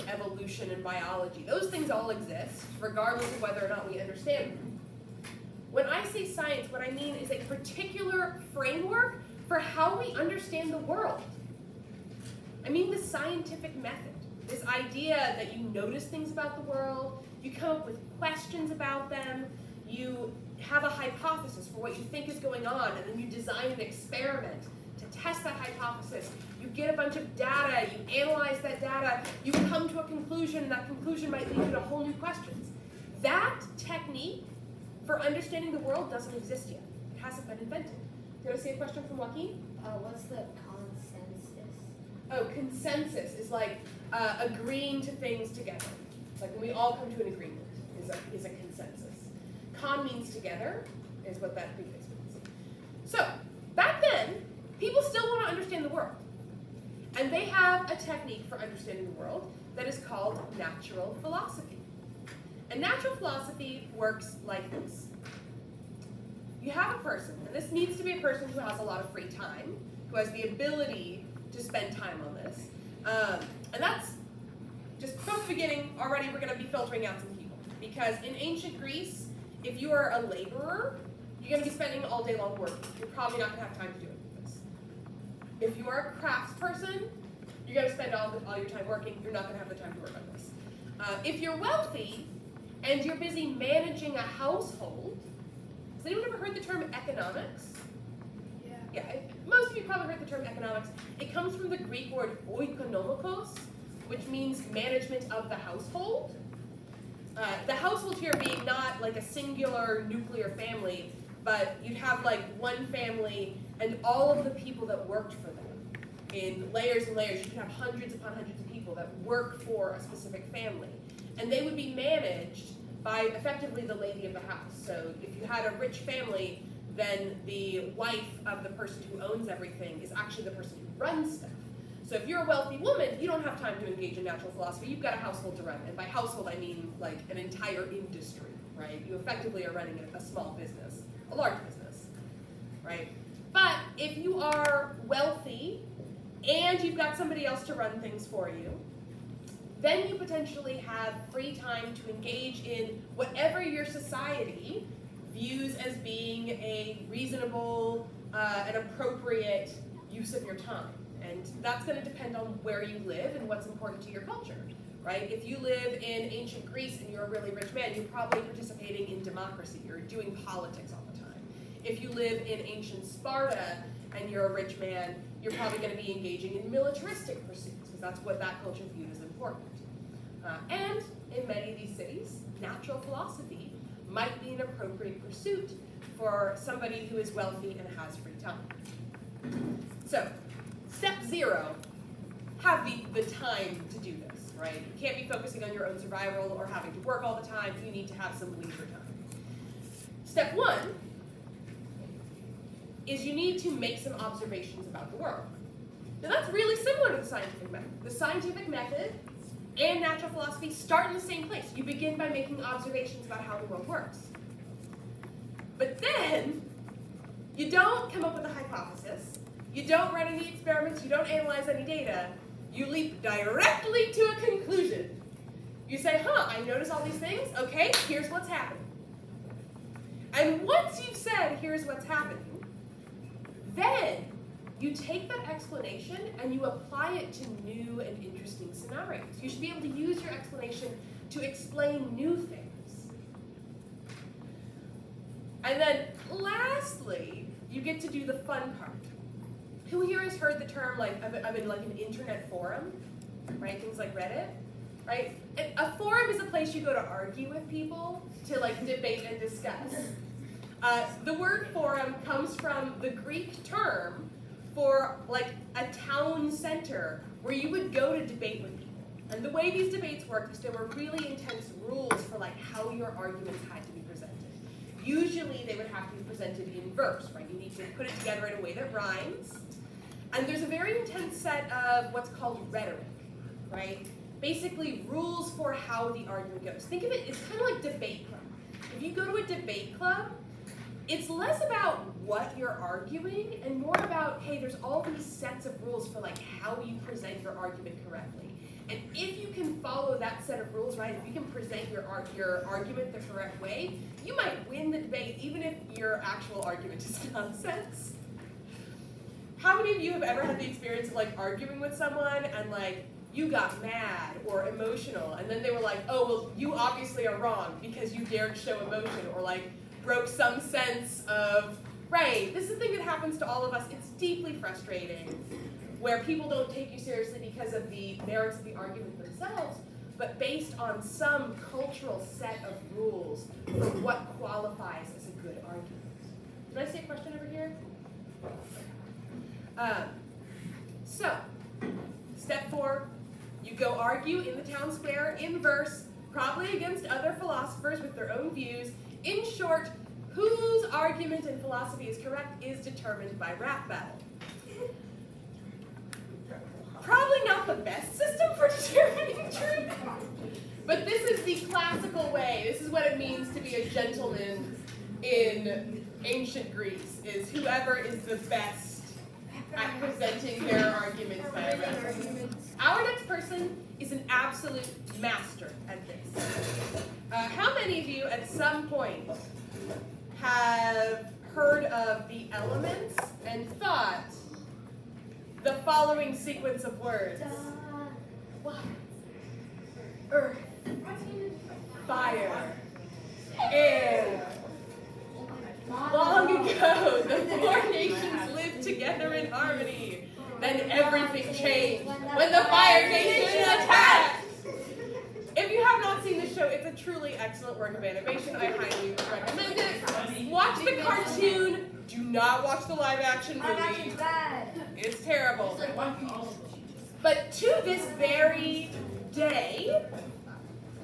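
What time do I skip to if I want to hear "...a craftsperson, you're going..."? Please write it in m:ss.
1:26.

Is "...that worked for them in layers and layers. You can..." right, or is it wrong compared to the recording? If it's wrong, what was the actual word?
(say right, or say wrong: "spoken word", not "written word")
right.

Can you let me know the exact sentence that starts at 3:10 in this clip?
So, step zero, have the, the time to do this, right?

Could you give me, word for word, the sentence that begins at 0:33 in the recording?
That technique for understanding the world doesn't exist yet.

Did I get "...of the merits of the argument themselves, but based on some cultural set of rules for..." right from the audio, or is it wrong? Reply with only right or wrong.
right.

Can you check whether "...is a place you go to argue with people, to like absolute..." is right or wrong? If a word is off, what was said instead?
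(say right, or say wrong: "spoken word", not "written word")
wrong: "debate", not "absolute".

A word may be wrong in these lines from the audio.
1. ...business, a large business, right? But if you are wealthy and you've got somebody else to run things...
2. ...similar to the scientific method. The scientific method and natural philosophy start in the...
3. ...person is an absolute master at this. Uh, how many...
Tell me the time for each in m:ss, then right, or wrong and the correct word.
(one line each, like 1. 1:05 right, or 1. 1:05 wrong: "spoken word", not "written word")
1. 2:20 right
2. 3:26 right
3. 6:13 right.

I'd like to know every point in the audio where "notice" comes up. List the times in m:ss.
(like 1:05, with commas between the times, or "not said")
0:15, 3:46.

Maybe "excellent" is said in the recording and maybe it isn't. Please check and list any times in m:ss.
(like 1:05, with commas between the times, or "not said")
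6:47.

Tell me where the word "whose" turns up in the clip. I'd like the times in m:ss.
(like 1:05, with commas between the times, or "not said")
5:50.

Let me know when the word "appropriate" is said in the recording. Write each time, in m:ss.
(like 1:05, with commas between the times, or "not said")
2:38, 3:04.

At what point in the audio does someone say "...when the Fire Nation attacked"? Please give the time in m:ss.
6:42.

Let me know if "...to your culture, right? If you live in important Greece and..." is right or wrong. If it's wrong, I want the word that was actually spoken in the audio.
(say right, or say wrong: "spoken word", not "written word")
wrong: "ancient", not "important".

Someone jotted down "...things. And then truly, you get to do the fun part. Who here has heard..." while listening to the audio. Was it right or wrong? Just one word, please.
wrong.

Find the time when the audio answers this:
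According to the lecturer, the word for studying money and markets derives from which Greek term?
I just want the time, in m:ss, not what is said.
1:42.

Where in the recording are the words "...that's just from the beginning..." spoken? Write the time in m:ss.
1:13.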